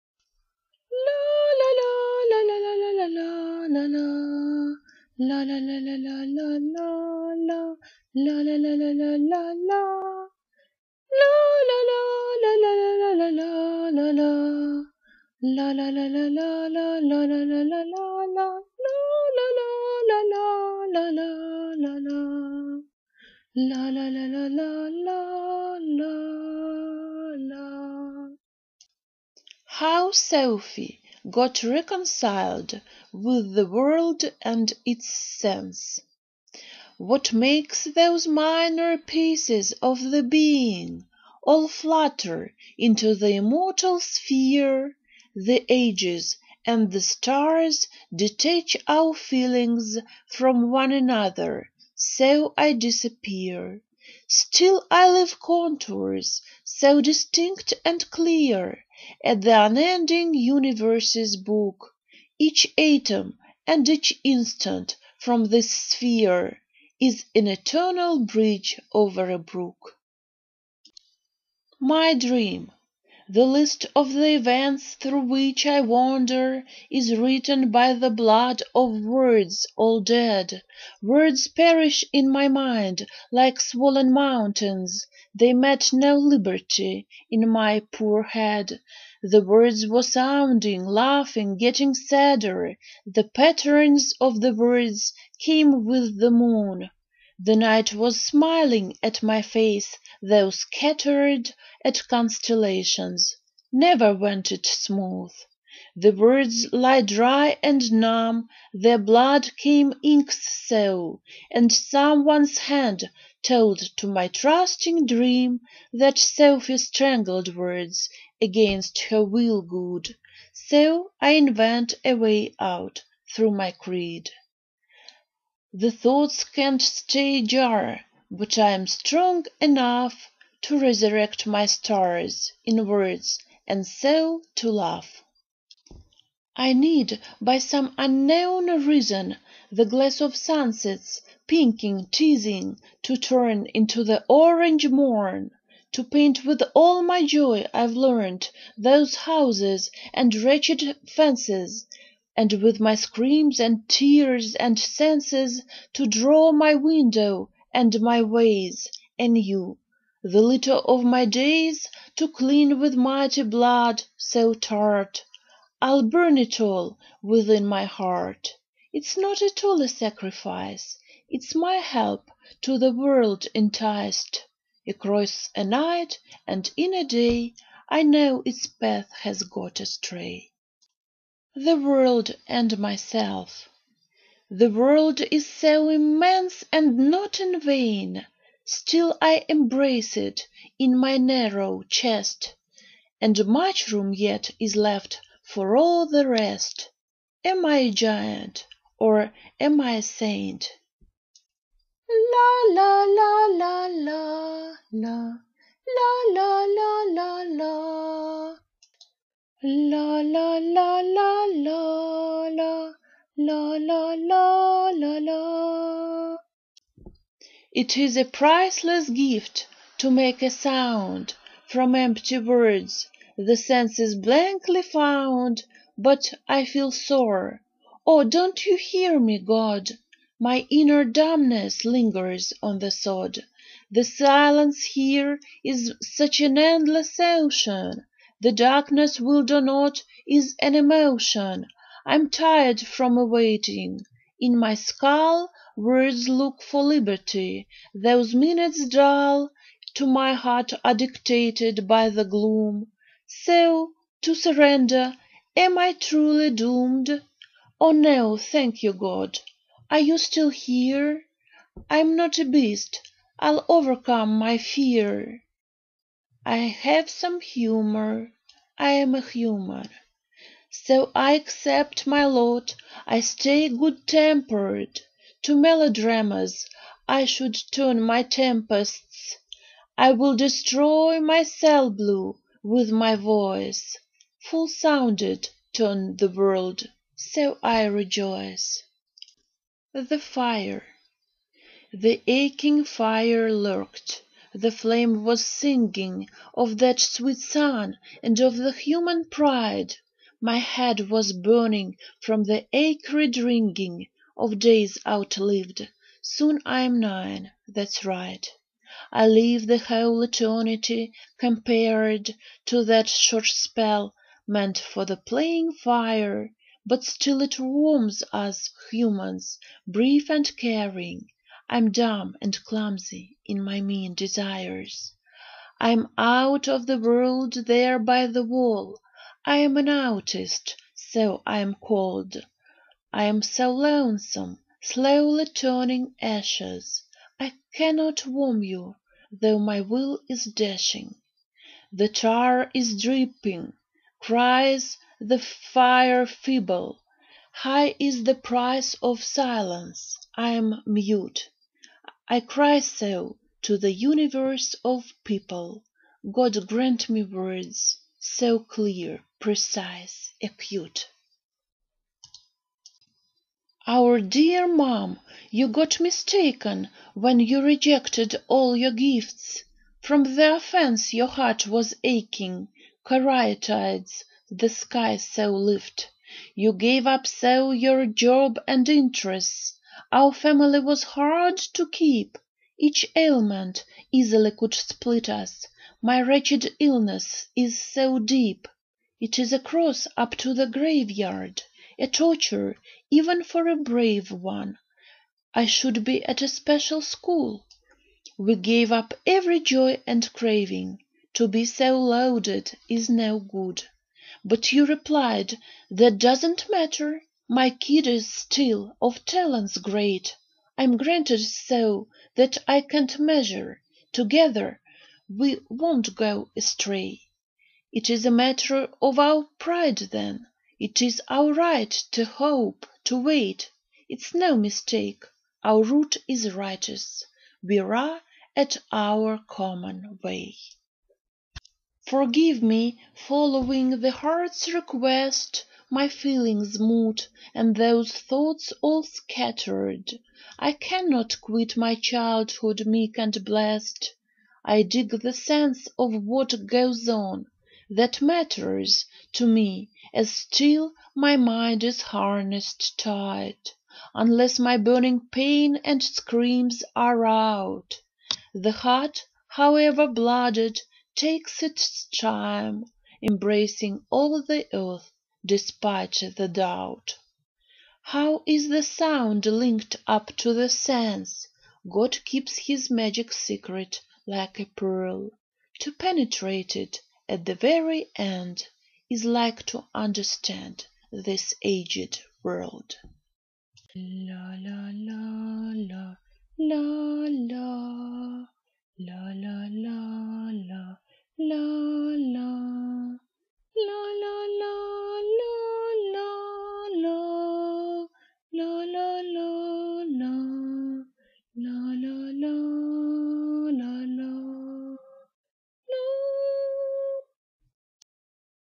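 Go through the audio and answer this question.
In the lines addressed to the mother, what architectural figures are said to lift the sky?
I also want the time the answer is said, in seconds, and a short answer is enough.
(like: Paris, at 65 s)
Caryatides, at 373 s.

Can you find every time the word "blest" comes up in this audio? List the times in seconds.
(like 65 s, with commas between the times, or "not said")
443 s.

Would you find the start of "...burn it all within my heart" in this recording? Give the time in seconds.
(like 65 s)
166 s.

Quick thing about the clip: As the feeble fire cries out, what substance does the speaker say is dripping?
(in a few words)
tar.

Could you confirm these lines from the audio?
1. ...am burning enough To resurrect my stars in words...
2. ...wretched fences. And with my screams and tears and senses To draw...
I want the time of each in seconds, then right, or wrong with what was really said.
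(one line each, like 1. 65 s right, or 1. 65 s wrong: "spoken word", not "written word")
1. 128 s wrong: "strong", not "burning"
2. 150 s right.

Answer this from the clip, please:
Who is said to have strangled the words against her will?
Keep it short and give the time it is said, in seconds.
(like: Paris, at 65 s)
Sophy, at 116 s.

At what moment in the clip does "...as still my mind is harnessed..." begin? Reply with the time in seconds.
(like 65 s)
450 s.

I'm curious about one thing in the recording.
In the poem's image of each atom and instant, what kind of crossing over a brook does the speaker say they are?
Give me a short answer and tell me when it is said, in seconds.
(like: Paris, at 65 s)
eternal bridge, at 67 s.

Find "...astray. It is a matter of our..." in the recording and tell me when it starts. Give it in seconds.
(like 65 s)
416 s.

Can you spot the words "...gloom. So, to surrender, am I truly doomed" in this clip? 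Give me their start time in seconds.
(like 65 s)
252 s.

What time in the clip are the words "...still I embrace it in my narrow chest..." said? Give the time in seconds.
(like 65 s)
188 s.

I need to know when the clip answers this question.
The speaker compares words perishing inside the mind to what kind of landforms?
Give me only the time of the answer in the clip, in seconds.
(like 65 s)
83 s.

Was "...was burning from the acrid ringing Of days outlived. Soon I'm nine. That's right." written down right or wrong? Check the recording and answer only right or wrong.
right.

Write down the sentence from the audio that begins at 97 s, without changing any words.
The night was smiling at my face, Though scattered at constellations, Never went it smooth.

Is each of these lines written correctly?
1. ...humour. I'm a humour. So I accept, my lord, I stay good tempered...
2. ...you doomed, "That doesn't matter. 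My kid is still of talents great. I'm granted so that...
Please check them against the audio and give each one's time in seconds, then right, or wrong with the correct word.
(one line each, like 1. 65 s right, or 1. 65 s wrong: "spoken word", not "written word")
1. 267 s right
2. 404 s wrong: "replied", not "doomed".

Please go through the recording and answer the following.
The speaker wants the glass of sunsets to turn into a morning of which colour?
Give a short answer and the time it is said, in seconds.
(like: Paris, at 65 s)
orange, at 144 s.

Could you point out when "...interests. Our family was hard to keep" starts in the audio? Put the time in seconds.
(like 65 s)
378 s.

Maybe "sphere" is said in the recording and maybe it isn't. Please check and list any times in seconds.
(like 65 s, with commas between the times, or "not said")
43 s, 65 s.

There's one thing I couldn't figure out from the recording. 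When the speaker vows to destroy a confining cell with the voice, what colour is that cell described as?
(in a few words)
blue.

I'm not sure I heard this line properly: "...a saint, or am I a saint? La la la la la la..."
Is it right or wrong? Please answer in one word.
wrong.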